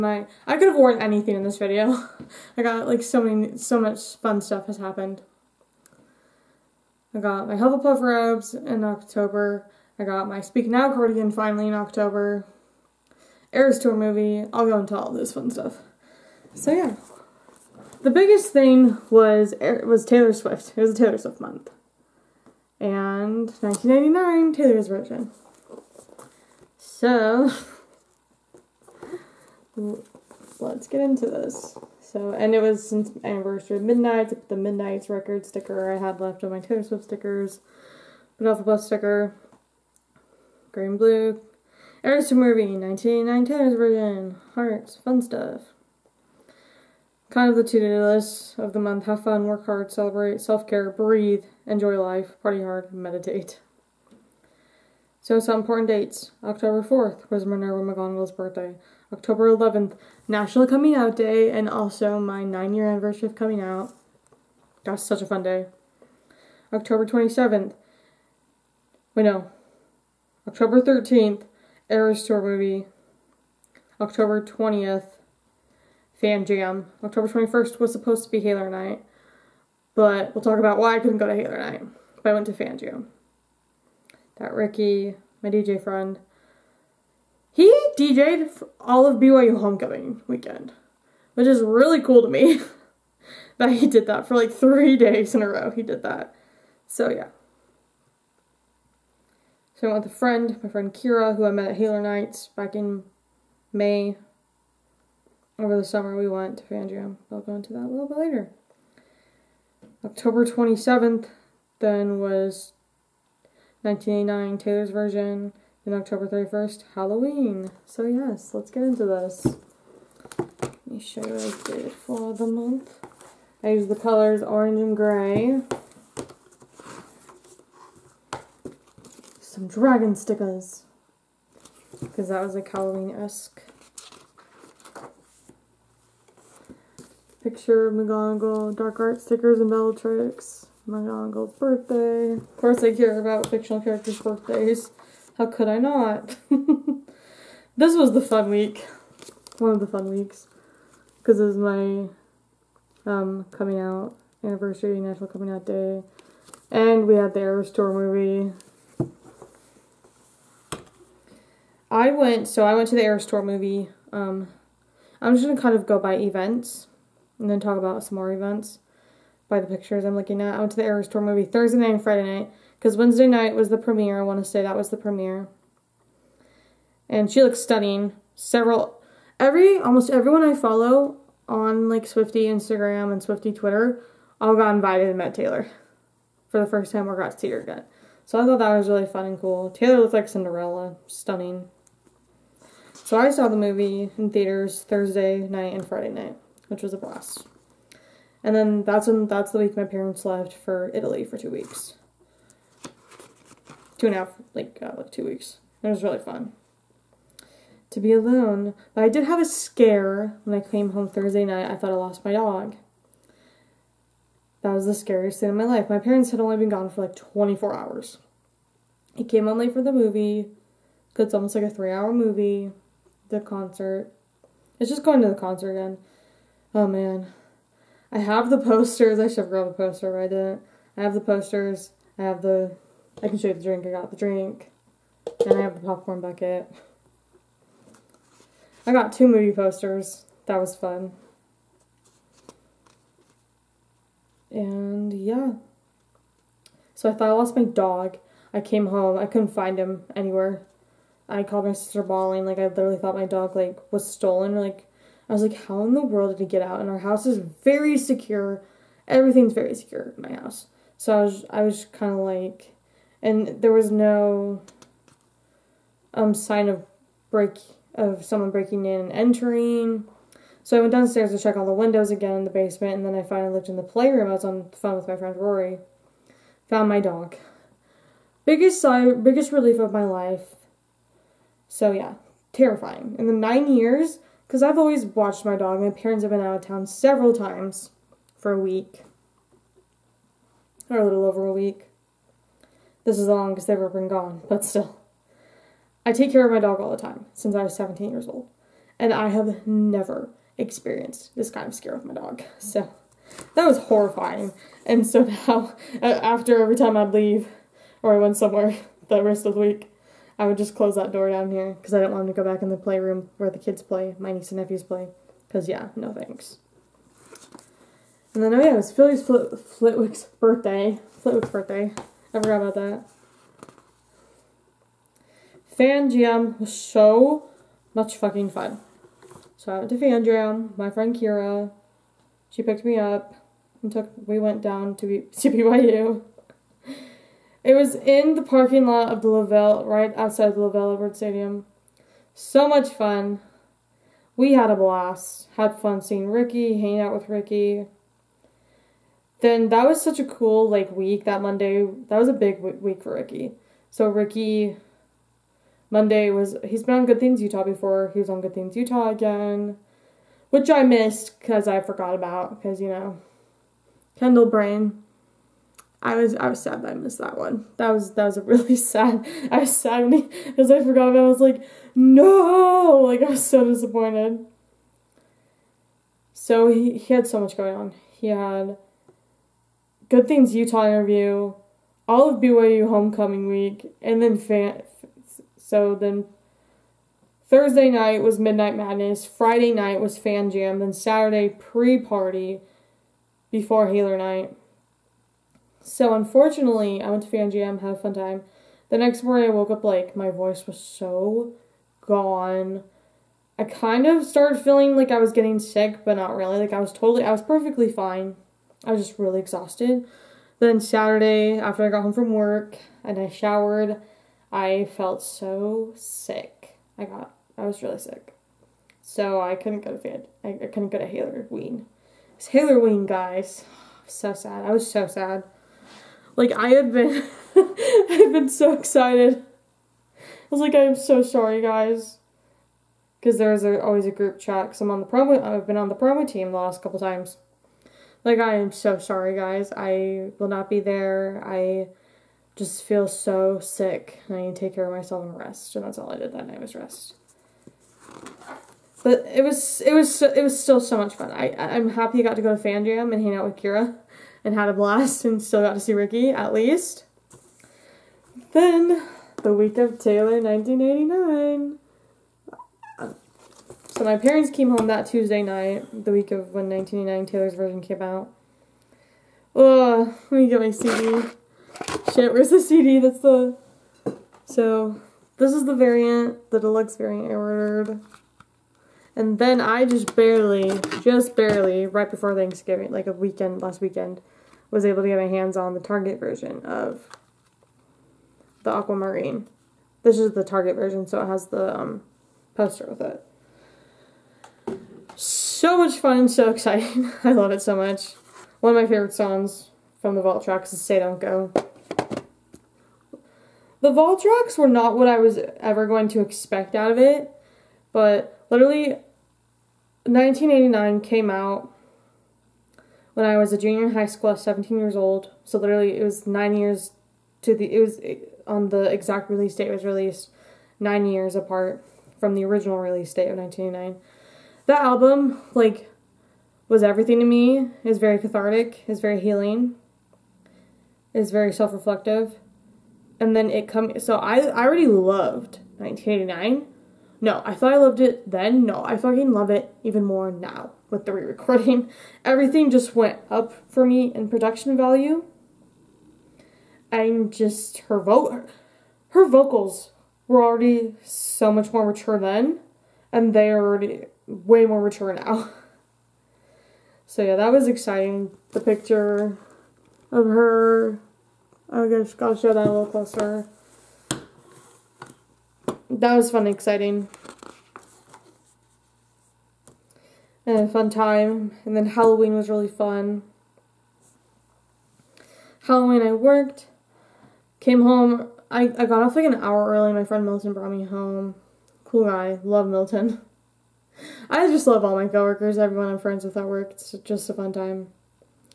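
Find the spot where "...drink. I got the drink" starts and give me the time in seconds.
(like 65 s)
233 s.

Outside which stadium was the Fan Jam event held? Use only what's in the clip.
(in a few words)
LaVell Edwards Stadium.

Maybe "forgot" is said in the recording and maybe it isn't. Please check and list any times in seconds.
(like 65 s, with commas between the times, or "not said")
322 s, 361 s, 370 s.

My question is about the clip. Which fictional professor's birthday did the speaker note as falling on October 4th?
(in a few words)
Minerva McGonagall.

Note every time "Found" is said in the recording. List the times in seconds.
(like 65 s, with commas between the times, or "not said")
276 s.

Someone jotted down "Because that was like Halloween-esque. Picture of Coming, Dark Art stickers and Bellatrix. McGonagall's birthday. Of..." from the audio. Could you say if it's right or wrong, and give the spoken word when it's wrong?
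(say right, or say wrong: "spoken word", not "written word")
wrong: "McGonagall", not "Coming".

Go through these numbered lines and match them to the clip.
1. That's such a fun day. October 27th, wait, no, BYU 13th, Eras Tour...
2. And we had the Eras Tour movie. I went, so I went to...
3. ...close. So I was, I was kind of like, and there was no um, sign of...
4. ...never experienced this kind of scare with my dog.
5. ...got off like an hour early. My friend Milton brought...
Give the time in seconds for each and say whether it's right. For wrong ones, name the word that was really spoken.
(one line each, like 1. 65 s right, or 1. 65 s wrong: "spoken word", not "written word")
1. 64 s wrong: "October", not "BYU"
2. 156 s right
3. 260 s wrong: "house", not "close"
4. 299 s right
5. 578 s right.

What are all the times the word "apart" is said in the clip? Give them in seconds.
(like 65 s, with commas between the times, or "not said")
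521 s.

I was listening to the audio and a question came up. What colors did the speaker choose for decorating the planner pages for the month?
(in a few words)
Orange and gray.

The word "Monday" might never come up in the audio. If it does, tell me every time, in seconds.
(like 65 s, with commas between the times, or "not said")
351 s, 355 s.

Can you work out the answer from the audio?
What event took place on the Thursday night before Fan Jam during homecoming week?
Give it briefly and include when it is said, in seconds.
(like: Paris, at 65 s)
Midnight Madness, at 388 s.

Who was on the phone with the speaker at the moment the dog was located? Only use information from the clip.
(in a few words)
Rory.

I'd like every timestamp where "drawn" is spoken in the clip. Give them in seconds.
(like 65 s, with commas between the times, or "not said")
not said.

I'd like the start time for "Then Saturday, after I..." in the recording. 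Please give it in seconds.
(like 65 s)
410 s.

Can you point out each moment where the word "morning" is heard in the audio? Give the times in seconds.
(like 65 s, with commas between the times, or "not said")
399 s.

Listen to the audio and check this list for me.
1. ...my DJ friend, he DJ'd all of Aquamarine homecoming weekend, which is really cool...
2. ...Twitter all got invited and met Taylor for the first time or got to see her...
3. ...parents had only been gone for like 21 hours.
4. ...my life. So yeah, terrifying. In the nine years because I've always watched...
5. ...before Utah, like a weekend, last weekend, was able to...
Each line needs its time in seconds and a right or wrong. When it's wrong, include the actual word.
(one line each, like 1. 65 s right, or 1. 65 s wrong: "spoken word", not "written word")
1. 85 s wrong: "BYU", not "Aquamarine"
2. 183 s right
3. 215 s wrong: "24", not "21"
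4. 279 s right
5. 482 s wrong: "Thanksgiving", not "Utah".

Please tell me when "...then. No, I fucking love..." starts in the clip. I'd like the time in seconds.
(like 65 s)
538 s.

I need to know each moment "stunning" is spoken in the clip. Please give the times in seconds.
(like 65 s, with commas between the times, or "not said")
177 s, 191 s.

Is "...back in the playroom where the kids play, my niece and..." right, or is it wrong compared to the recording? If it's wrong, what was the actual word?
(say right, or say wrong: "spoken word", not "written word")
right.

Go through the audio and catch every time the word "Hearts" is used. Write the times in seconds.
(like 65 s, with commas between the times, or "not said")
44 s.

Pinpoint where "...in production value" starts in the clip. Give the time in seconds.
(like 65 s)
544 s.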